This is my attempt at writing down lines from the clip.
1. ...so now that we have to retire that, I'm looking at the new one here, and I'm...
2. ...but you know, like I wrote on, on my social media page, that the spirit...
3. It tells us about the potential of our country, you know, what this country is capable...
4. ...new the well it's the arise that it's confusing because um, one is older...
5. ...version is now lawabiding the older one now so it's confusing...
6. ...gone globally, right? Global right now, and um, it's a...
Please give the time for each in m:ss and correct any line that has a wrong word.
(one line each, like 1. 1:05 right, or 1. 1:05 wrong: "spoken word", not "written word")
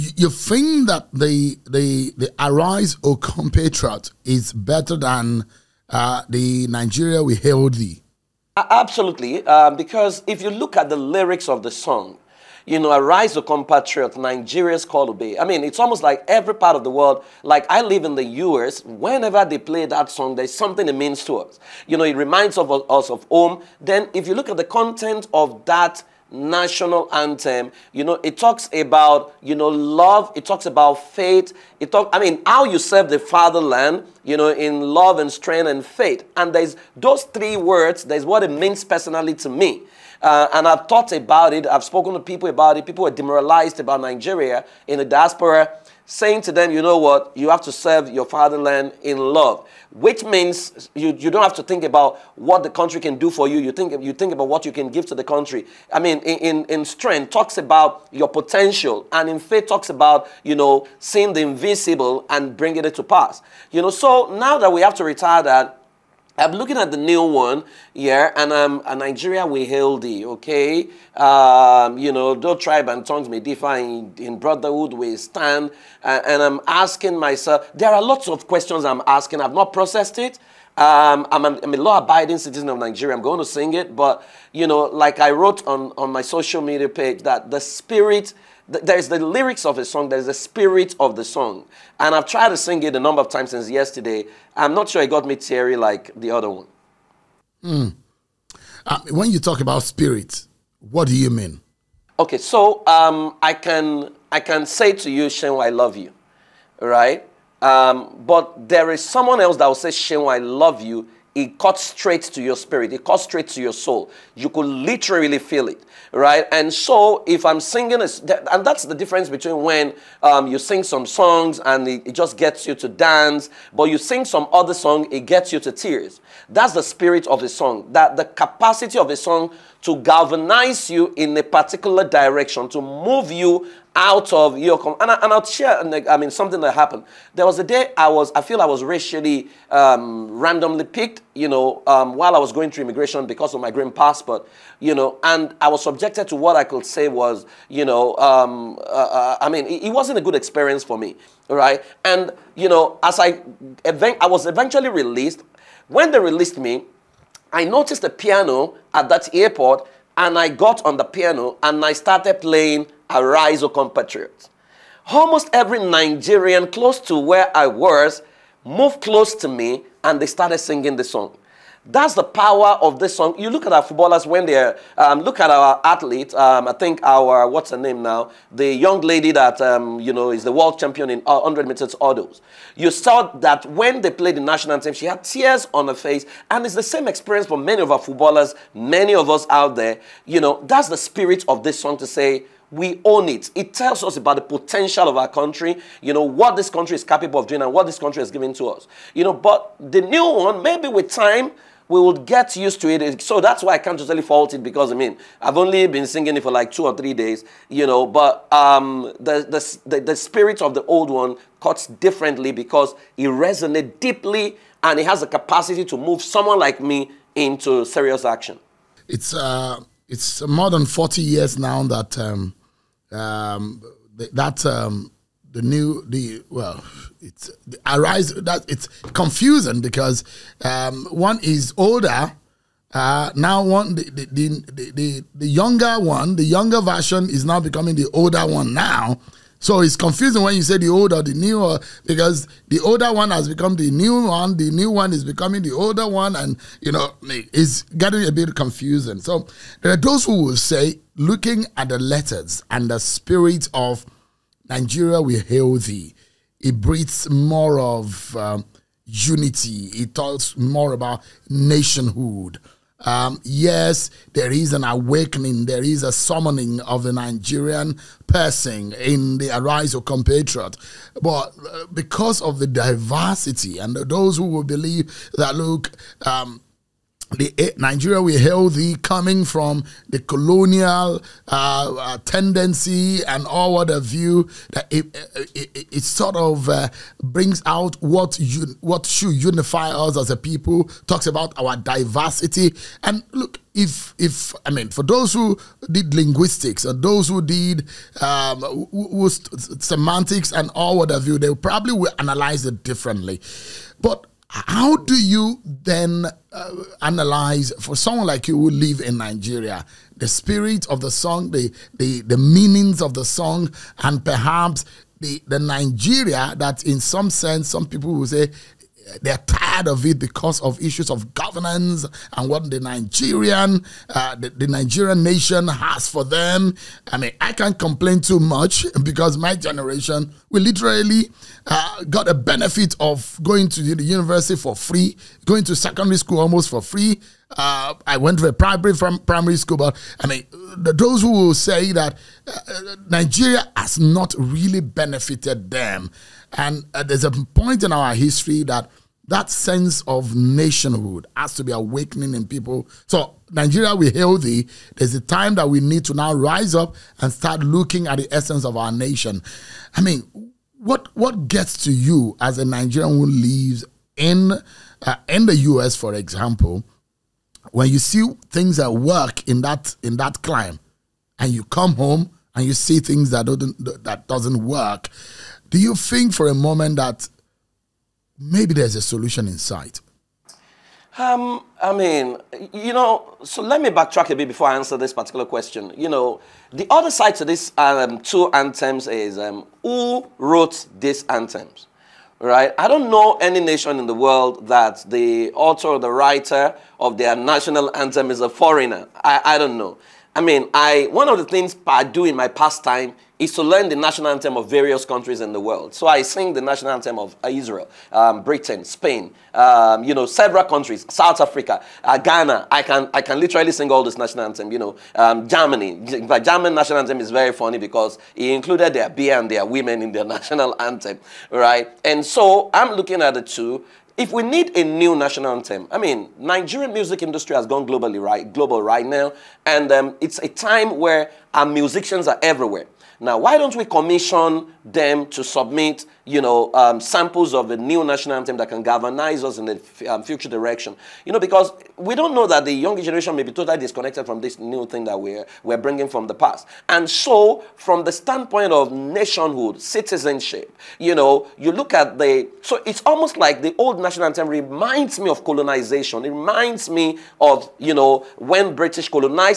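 1. 1:03 right
2. 1:23 right
3. 3:13 right
4. 3:45 right
5. 3:56 wrong: "becoming", not "lawabiding"
6. 7:07 right.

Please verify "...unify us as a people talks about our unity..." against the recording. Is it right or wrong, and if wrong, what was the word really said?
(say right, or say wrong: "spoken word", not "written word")
wrong: "diversity", not "unity".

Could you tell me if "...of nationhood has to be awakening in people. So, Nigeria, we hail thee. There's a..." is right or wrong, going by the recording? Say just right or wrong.
right.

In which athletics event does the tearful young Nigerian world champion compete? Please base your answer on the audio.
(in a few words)
100 meters hurdles.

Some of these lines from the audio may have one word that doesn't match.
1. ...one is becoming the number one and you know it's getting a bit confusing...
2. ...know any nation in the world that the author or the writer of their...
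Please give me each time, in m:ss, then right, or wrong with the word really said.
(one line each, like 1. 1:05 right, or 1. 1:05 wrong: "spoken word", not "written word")
1. 4:04 wrong: "older", not "number"
2. 6:33 right.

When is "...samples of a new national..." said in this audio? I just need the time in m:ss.
7:17.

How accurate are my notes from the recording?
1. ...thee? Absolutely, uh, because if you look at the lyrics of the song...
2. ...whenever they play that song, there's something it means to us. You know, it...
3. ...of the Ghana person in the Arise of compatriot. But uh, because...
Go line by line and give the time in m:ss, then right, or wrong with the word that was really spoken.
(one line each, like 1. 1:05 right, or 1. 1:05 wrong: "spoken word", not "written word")
1. 0:07 right
2. 0:18 right
3. 4:26 wrong: "Nigerian", not "Ghana".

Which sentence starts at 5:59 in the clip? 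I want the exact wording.
I mean, what what gets to you as a Nigerian who lives in uh, in the U.S., for example?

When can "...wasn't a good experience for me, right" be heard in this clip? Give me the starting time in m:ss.
2:29.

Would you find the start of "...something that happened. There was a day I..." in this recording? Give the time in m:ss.
2:16.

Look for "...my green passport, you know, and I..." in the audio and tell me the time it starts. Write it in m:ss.
2:23.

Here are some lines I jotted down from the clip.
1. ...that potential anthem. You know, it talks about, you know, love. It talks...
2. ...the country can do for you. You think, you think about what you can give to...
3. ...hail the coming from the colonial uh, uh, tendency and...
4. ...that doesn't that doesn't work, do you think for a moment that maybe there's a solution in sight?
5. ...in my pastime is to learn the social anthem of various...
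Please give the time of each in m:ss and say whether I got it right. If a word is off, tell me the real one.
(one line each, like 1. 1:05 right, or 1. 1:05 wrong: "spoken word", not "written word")
1. 0:25 wrong: "national", not "potential"
2. 0:52 right
3. 4:38 right
4. 6:13 right
5. 6:42 wrong: "national", not "social".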